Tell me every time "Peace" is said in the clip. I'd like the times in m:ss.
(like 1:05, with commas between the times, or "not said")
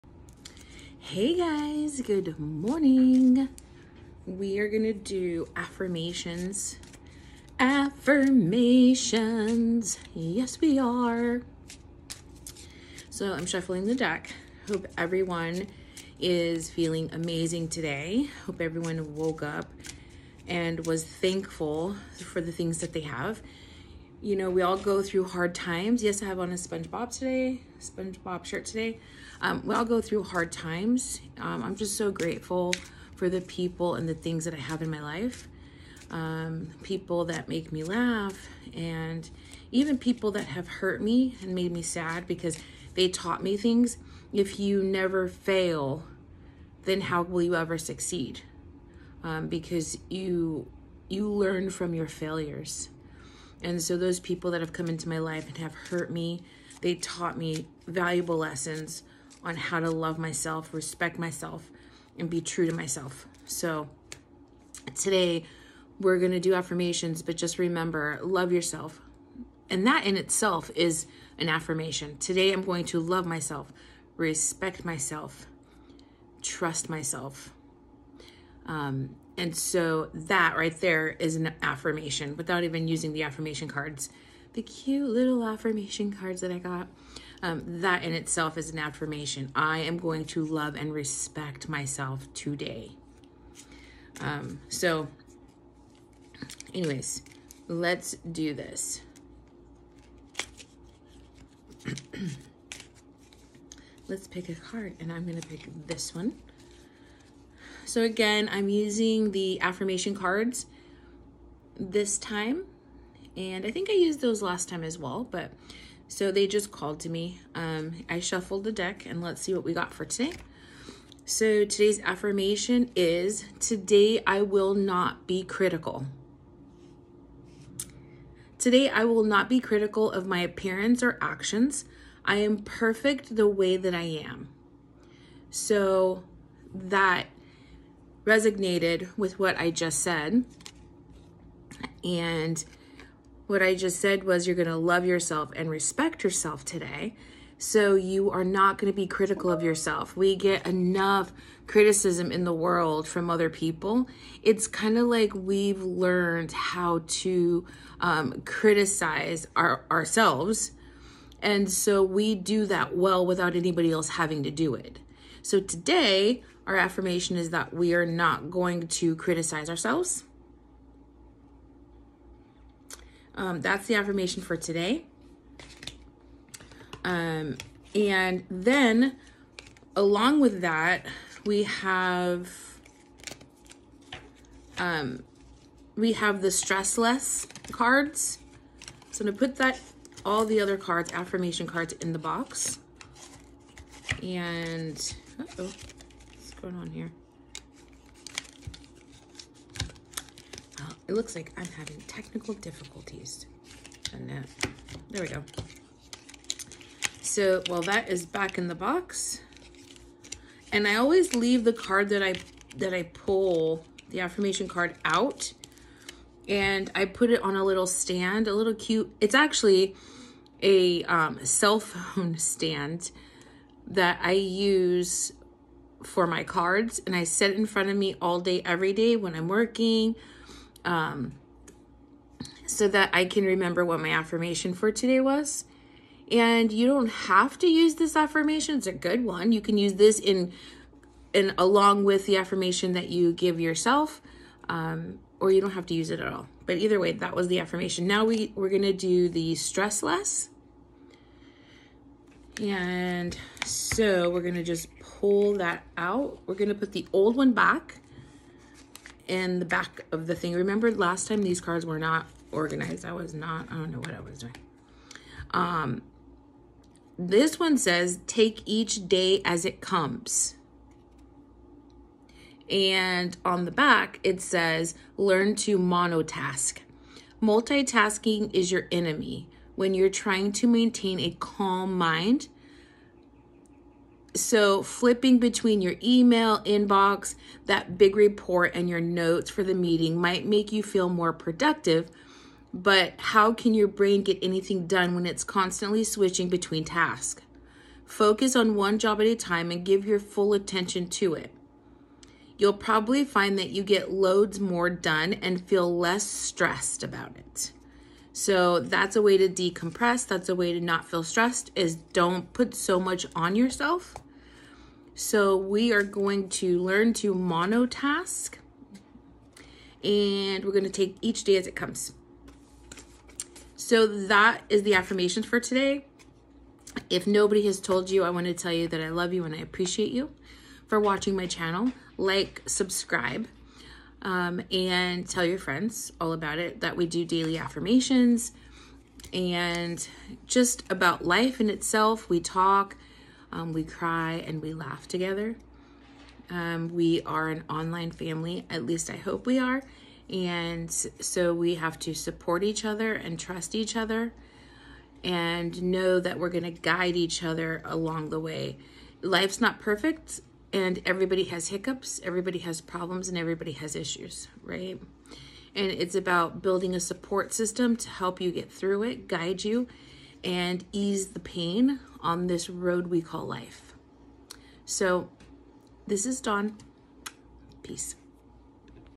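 6:17.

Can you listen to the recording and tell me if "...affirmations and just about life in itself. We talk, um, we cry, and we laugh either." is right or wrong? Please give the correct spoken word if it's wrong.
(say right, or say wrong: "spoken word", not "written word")
wrong: "together", not "either".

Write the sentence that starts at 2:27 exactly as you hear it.
So you are not going to be critical of yourself.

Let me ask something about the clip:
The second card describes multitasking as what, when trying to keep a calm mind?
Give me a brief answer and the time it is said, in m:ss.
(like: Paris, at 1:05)
your enemy, at 4:38.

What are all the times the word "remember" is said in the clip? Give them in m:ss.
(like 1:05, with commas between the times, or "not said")
1:07, 3:53, 4:20.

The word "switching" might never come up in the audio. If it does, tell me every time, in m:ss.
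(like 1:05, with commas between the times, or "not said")
4:56.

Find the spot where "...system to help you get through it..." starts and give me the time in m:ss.
6:07.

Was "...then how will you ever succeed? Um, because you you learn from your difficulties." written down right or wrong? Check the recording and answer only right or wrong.
wrong.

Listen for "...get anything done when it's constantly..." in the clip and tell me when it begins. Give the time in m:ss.
4:54.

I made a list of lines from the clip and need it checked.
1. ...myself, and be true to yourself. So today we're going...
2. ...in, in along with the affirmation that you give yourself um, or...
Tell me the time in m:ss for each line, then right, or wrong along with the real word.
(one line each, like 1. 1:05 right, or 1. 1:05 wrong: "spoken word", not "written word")
1. 1:01 wrong: "myself", not "yourself"
2. 4:00 right.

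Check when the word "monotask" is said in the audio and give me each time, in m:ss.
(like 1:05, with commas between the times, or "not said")
4:35, 5:17.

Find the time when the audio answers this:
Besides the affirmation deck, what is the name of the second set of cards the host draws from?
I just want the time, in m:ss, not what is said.
3:06.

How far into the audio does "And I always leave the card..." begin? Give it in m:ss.
3:30.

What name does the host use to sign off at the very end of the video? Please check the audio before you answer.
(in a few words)
Dawn.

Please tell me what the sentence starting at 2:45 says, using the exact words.
So today, our affirmation is that we are not going to criticize ourselves.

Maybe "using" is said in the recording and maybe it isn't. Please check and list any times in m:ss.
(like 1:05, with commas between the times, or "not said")
1:22, 1:48.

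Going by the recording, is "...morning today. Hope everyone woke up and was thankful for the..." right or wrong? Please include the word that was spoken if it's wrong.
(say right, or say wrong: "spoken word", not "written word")
wrong: "amazing", not "morning".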